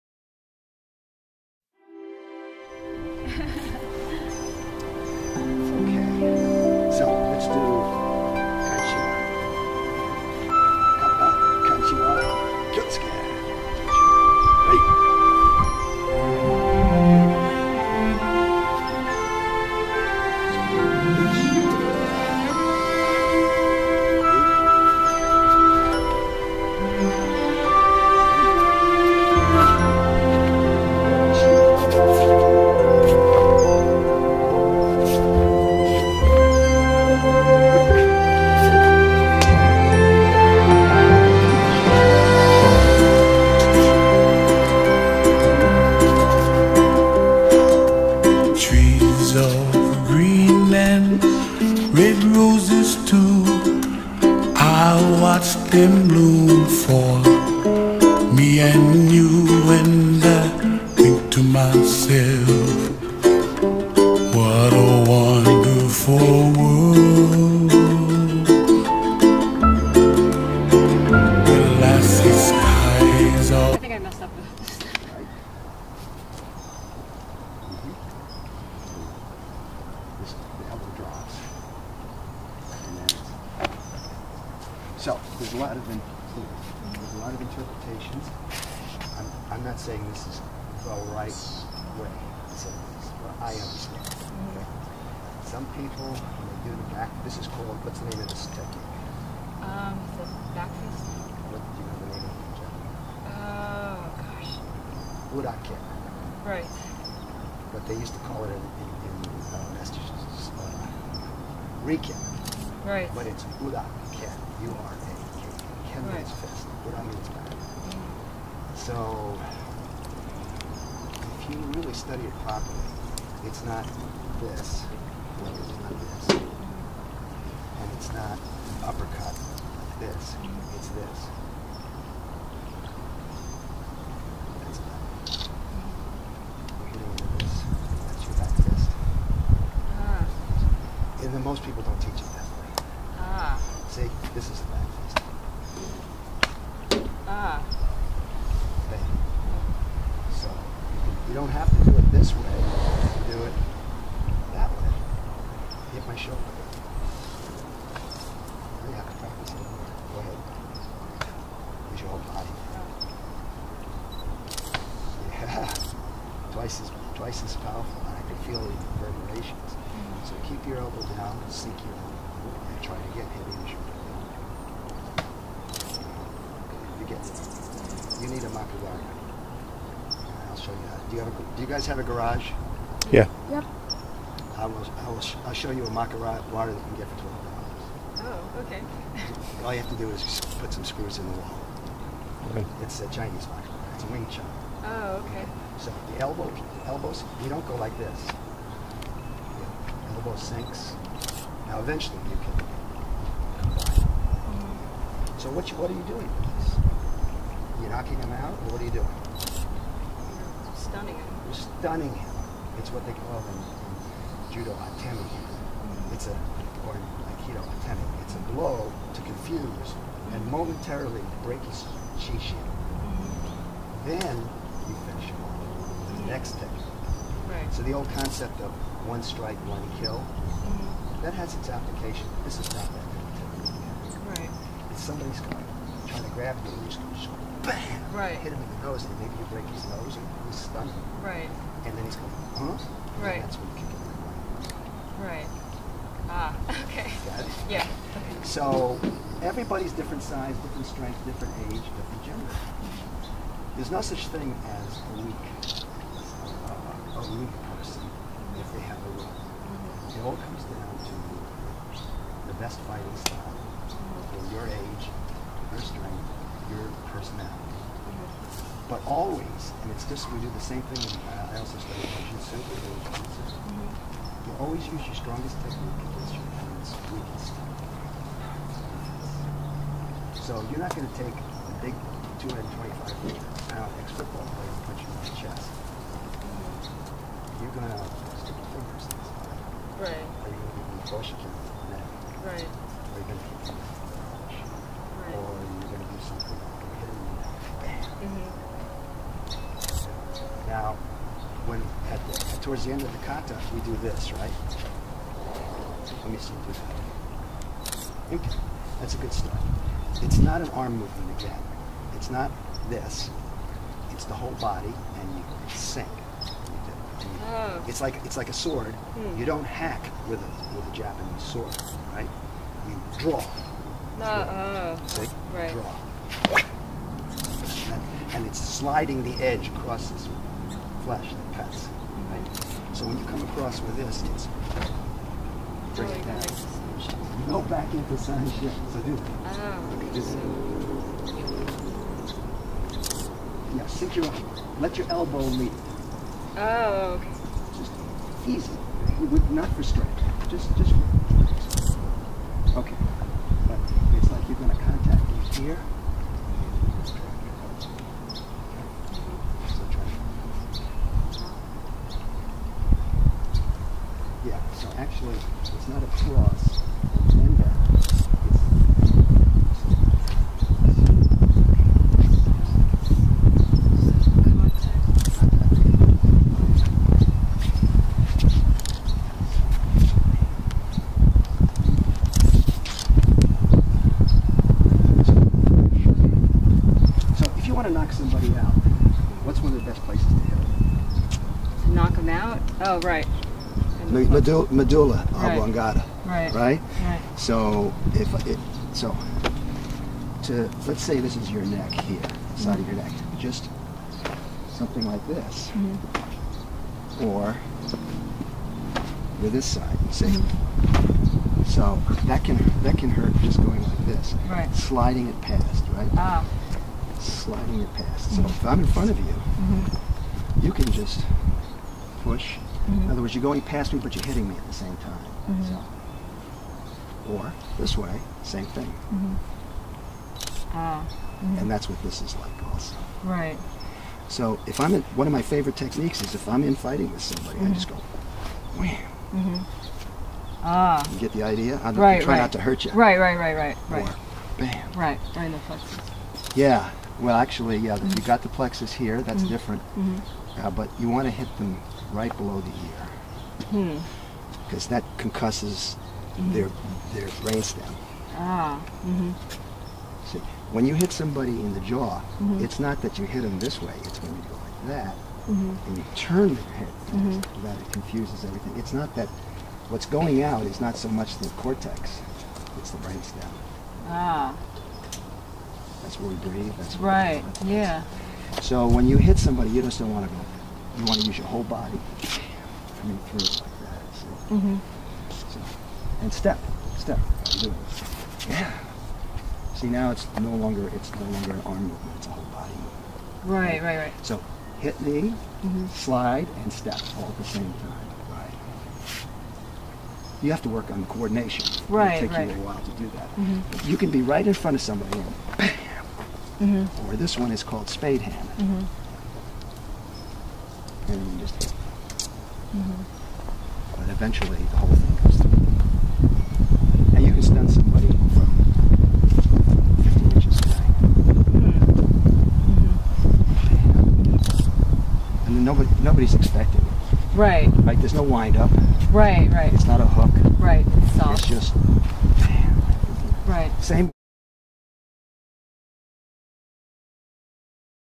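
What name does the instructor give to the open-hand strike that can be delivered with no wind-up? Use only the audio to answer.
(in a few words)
spade hand.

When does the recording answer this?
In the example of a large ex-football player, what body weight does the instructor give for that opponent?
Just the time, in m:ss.
4:42.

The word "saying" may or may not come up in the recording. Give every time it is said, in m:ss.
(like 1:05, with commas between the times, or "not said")
1:29.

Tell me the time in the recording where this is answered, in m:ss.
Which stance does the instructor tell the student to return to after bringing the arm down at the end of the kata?
5:38.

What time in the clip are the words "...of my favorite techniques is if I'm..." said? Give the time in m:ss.
7:15.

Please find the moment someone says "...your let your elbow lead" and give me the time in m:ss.
5:44.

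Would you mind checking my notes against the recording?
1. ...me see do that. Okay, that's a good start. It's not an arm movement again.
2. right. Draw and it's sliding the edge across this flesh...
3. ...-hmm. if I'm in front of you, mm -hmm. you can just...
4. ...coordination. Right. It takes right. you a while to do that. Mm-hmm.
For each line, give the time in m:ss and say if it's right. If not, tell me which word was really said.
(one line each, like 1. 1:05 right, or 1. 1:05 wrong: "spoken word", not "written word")
1. 5:06 right
2. 5:25 right
3. 6:58 right
4. 8:21 right.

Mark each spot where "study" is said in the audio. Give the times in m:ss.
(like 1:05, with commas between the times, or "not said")
2:01, 4:31.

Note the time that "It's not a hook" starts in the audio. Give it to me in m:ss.
8:49.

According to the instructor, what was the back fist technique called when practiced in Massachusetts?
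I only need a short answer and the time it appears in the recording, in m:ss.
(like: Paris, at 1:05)
Rikin, at 1:51.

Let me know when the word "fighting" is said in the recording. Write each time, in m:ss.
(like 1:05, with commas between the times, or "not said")
4:22, 7:16.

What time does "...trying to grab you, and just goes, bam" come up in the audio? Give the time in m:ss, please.
3:56.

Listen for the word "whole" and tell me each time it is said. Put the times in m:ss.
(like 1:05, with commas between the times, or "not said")
2:42, 5:14, 8:01, 8:12, 8:34.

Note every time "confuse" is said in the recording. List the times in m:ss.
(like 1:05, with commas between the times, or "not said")
3:39, 7:47.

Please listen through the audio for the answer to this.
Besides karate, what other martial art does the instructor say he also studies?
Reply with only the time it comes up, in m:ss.
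4:32.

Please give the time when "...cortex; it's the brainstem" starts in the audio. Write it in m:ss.
7:51.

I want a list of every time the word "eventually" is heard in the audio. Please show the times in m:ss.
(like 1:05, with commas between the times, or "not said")
3:21, 8:34.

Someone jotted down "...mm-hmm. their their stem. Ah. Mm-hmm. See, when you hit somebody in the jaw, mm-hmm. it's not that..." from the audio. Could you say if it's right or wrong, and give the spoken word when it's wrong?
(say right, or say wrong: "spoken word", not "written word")
right.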